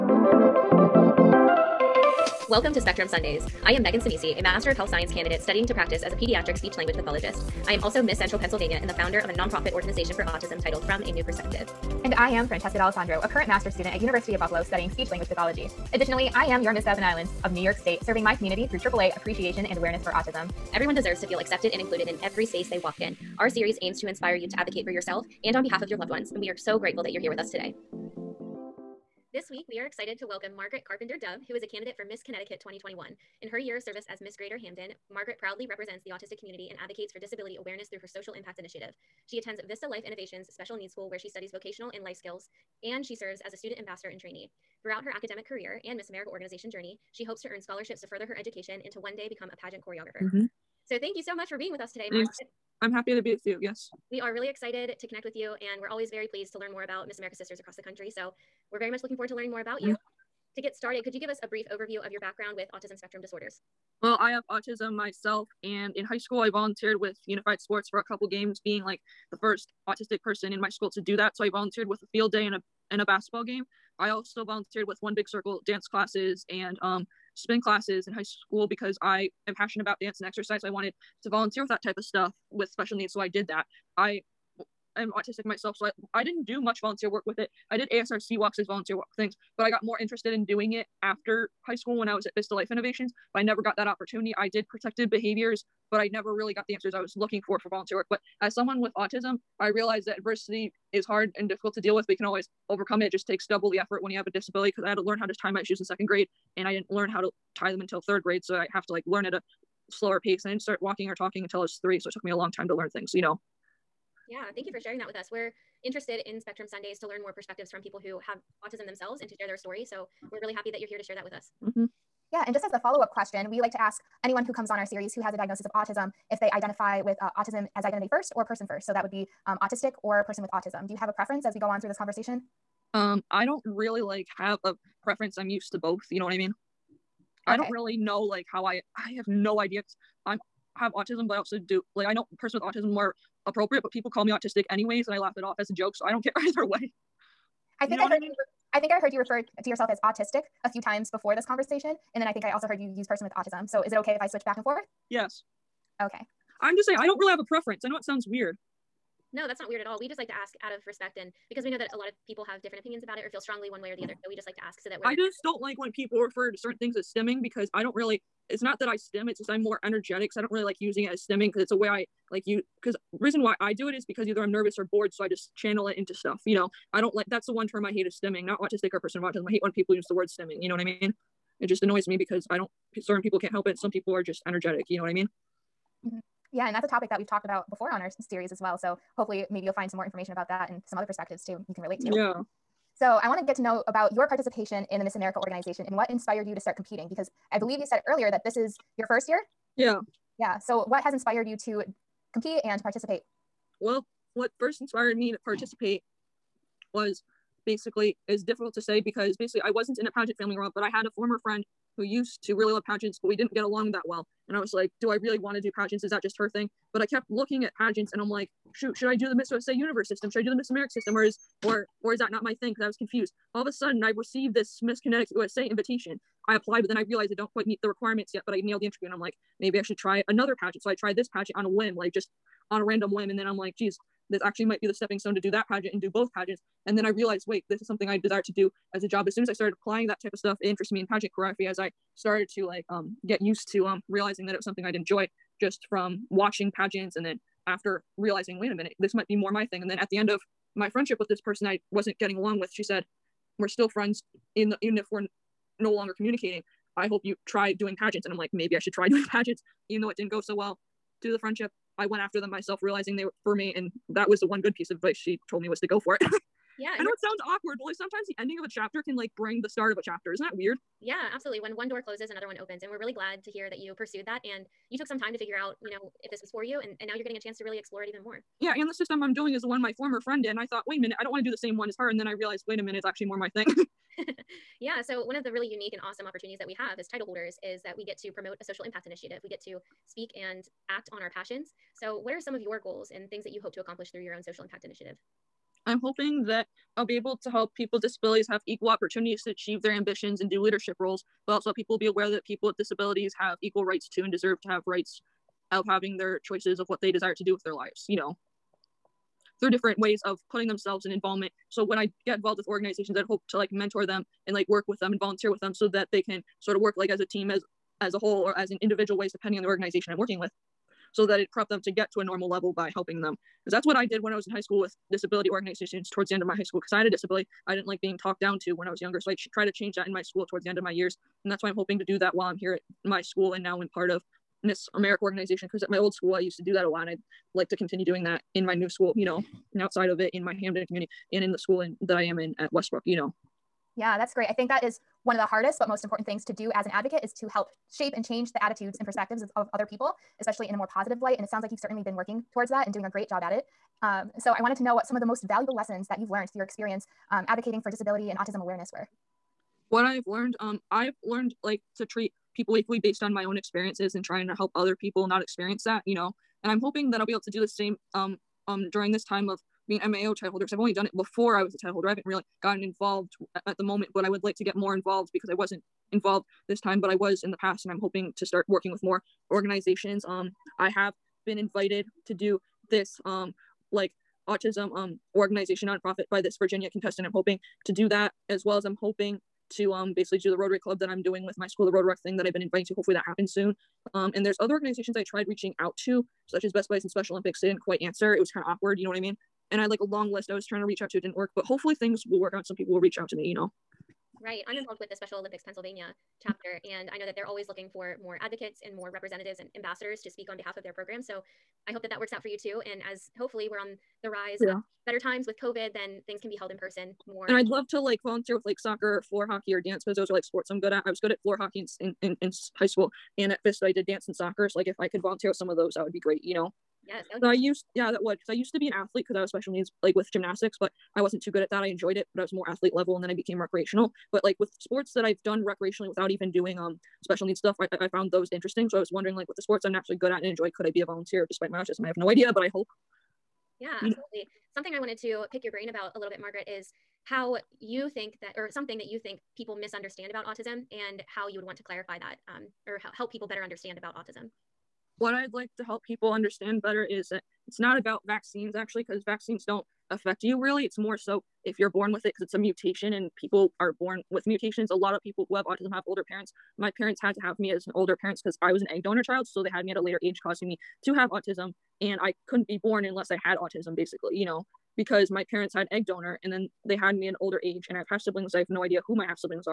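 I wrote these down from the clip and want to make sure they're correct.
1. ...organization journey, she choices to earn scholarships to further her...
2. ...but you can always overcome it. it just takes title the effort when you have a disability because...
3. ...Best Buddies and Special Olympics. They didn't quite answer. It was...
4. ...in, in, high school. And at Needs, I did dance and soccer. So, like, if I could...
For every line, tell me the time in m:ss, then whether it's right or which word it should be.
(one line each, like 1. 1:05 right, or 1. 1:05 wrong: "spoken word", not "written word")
1. 0:46 wrong: "hopes", not "choices"
2. 1:42 wrong: "double", not "title"
3. 6:36 right
4. 7:02 wrong: "Vista", not "Needs".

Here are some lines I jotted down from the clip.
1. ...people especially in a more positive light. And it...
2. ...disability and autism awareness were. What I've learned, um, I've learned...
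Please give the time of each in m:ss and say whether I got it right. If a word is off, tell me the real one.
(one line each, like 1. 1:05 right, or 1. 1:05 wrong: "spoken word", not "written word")
1. 5:49 right
2. 5:57 right.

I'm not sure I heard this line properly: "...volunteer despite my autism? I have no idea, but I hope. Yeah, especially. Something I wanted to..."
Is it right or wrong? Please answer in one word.
wrong.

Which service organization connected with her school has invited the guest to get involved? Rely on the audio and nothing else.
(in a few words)
Rotary Club.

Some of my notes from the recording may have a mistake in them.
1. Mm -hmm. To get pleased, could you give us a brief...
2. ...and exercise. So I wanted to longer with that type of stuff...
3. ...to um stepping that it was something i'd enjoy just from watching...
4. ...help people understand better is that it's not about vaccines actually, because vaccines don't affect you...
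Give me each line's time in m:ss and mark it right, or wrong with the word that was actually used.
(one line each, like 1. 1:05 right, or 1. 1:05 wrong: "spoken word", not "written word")
1. 0:59 wrong: "started", not "pleased"
2. 1:20 wrong: "volunteer", not "longer"
3. 4:03 wrong: "realizing", not "stepping"
4. 7:35 right.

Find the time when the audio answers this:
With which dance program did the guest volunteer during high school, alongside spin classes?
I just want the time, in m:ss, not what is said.
1:15.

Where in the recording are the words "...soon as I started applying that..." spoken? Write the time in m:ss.
3:59.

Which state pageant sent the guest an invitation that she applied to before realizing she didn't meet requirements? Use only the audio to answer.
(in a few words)
Miss Connecticut USA.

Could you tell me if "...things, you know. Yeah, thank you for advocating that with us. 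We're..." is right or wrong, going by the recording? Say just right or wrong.
wrong.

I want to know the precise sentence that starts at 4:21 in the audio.
To the friendship, I went after them myself, realizing they were for me.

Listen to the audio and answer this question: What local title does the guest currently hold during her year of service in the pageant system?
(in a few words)
Miss Greater Hamden.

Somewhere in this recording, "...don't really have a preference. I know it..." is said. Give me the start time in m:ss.
2:37.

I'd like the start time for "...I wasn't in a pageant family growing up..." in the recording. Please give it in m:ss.
3:29.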